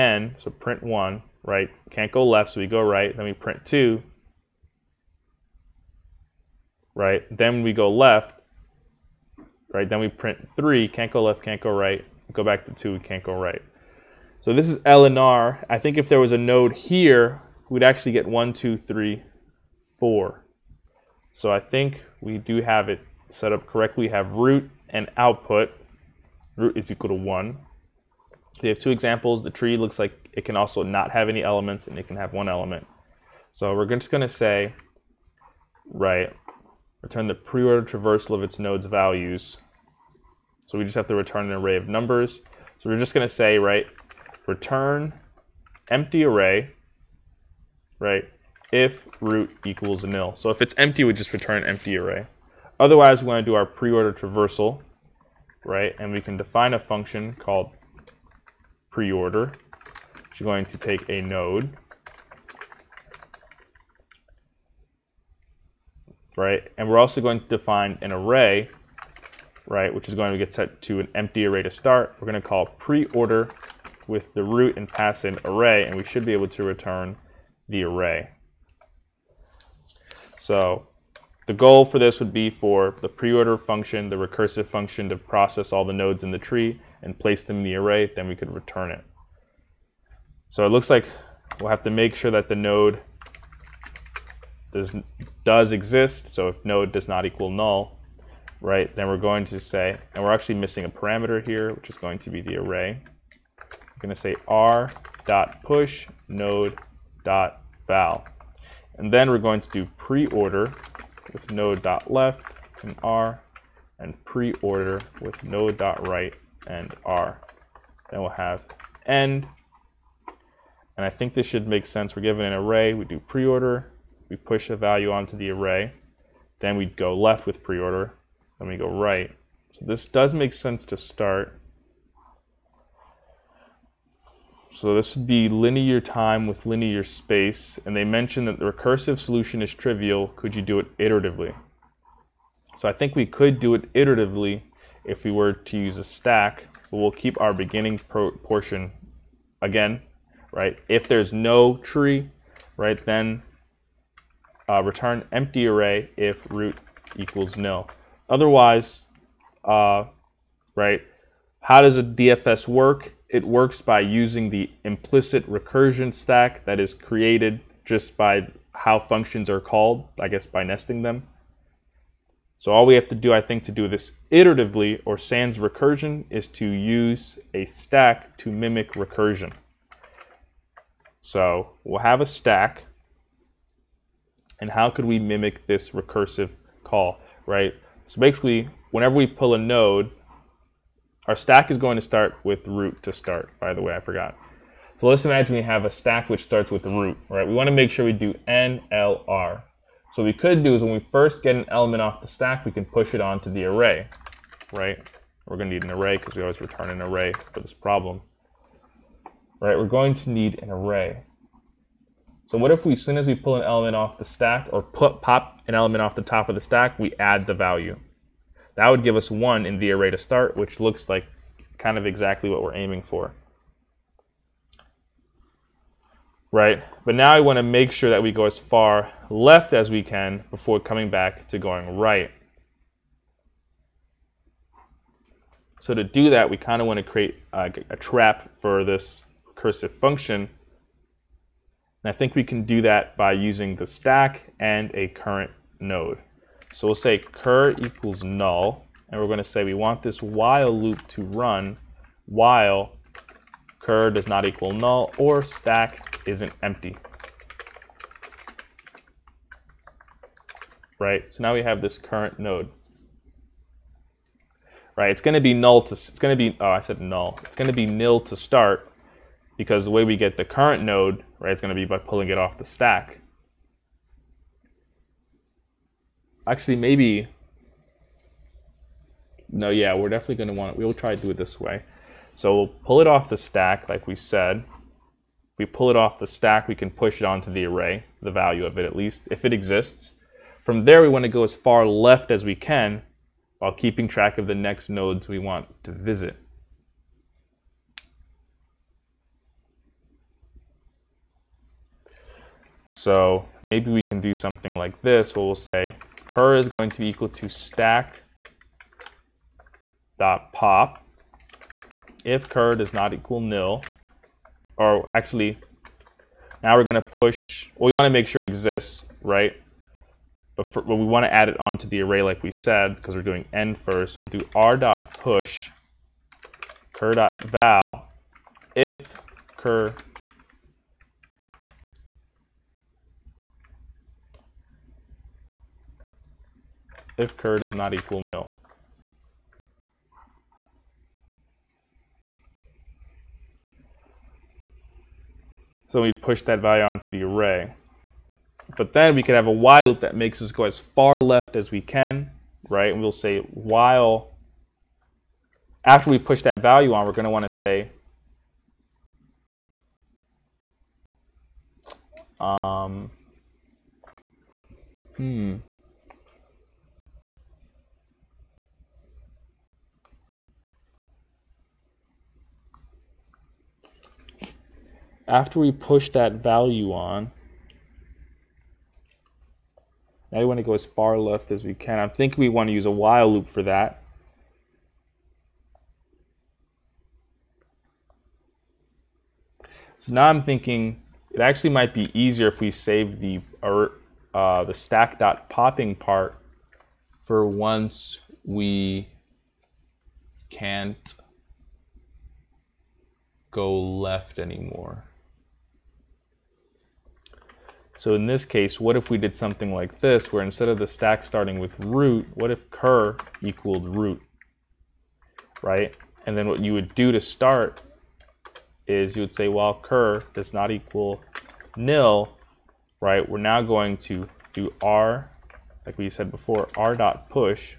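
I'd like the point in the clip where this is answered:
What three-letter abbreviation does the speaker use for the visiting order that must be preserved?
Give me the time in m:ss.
3:18.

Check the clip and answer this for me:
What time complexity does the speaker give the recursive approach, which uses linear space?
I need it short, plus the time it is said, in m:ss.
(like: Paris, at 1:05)
linear time, at 2:15.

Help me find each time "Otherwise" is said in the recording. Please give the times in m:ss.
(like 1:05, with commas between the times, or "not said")
0:52, 2:38.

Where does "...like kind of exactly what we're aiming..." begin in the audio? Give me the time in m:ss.
3:41.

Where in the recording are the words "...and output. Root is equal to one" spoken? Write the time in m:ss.
0:24.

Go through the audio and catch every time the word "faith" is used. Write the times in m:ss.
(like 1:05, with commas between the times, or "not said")
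not said.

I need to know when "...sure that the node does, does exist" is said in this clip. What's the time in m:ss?
1:32.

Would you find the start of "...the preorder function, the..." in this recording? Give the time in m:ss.
1:23.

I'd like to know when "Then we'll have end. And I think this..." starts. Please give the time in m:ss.
1:58.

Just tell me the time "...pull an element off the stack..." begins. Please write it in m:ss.
3:33.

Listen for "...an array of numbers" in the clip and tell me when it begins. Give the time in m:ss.
0:41.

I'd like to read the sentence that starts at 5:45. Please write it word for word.
So we push that value onto the array.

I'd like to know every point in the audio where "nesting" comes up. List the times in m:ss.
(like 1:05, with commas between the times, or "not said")
2:50.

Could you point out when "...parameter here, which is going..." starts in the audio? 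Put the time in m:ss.
1:40.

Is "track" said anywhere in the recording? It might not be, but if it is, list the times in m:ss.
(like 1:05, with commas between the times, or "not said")
4:54.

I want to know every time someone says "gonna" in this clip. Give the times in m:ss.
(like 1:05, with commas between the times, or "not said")
0:34, 0:43.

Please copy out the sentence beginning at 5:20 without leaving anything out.
But, for, we want to add it onto the array like we said, because we're doing n first.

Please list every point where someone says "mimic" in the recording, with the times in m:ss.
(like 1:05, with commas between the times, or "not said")
2:58, 3:05.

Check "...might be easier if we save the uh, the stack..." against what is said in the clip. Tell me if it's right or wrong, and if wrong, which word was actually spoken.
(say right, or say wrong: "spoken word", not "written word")
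right.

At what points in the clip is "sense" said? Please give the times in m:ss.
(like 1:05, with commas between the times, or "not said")
2:01, 2:10.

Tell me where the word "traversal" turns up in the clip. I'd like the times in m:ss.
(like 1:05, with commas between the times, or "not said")
0:37, 0:54.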